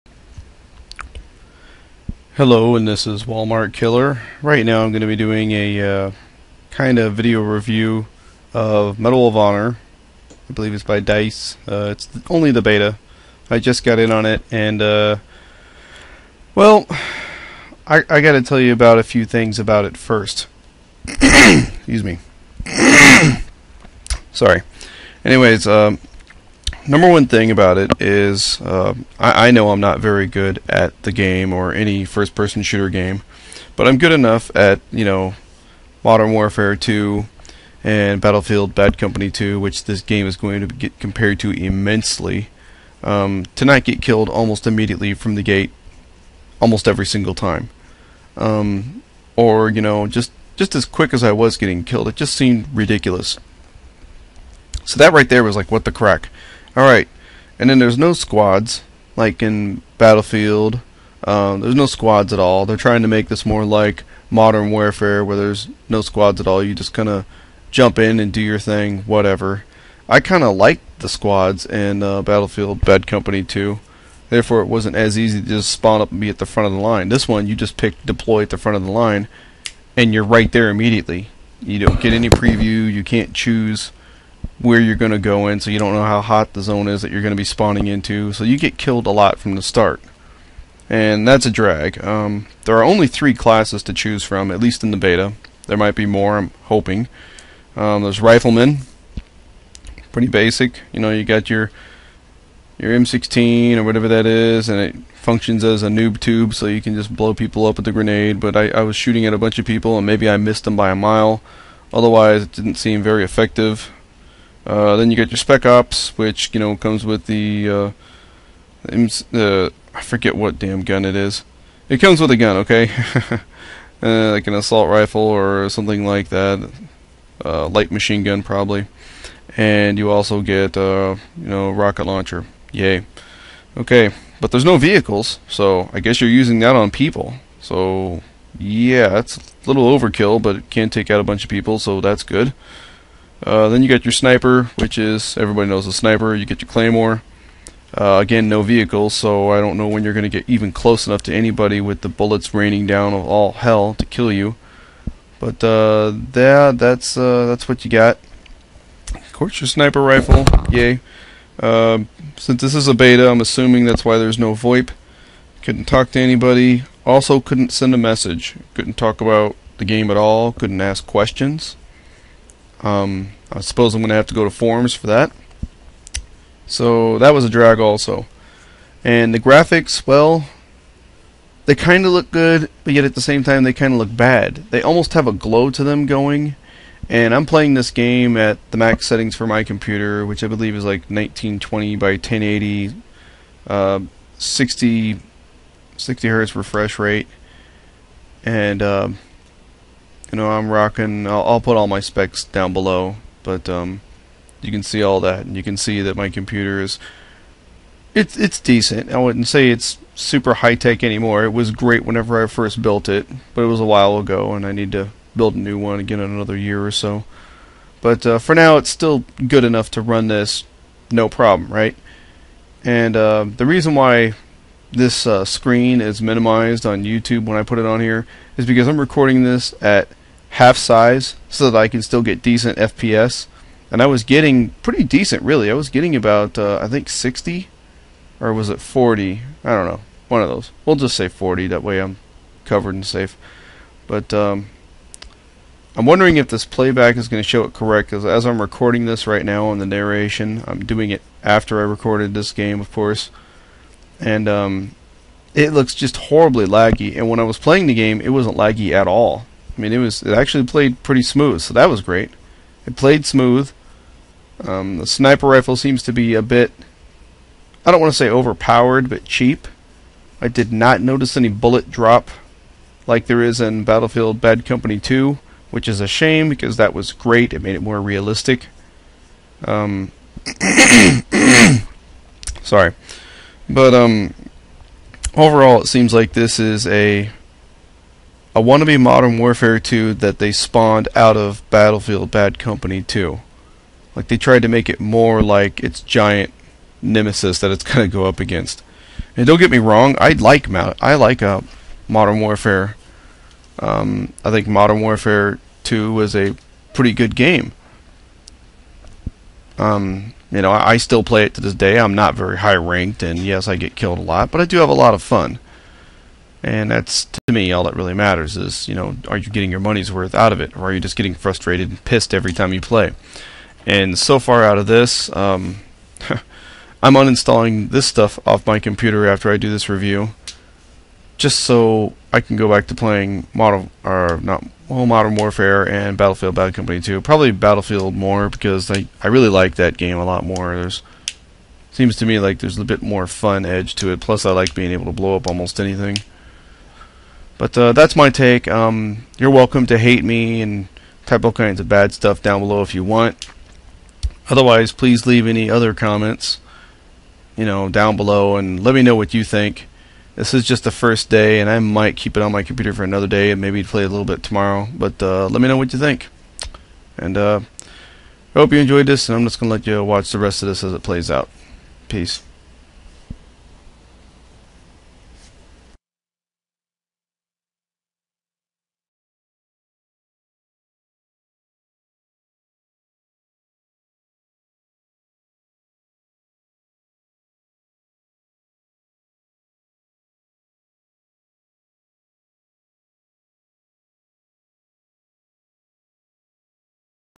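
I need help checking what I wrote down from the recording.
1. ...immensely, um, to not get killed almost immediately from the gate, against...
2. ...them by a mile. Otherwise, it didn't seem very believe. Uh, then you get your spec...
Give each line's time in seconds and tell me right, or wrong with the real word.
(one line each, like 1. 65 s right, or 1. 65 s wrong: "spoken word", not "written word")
1. 41 s wrong: "almost", not "against"
2. 110 s wrong: "effective", not "believe".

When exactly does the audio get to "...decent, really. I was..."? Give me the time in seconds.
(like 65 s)
235 s.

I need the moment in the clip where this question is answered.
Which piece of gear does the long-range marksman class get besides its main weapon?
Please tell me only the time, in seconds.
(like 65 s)
146 s.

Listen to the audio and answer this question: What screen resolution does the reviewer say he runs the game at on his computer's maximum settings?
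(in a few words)
1920 by 1080.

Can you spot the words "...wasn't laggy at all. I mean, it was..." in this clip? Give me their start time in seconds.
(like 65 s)
258 s.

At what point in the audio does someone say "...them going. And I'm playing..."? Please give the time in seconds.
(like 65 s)
185 s.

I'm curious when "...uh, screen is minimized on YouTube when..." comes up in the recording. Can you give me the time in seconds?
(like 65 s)
225 s.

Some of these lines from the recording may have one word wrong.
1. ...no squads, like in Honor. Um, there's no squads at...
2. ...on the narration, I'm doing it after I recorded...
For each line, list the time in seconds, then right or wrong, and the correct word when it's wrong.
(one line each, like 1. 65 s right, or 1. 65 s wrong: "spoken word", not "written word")
1. 57 s wrong: "Battlefield", not "Honor"
2. 249 s right.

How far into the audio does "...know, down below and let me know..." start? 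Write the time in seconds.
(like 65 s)
357 s.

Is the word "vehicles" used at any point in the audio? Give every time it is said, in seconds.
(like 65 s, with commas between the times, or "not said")
134 s, 148 s.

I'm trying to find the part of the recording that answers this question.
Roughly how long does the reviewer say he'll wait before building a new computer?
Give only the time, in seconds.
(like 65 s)
216 s.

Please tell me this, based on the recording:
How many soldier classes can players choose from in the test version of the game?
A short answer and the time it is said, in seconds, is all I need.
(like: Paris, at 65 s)
3, at 93 s.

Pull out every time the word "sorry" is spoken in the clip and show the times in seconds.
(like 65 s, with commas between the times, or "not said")
24 s, 282 s.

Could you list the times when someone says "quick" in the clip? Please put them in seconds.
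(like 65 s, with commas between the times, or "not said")
50 s.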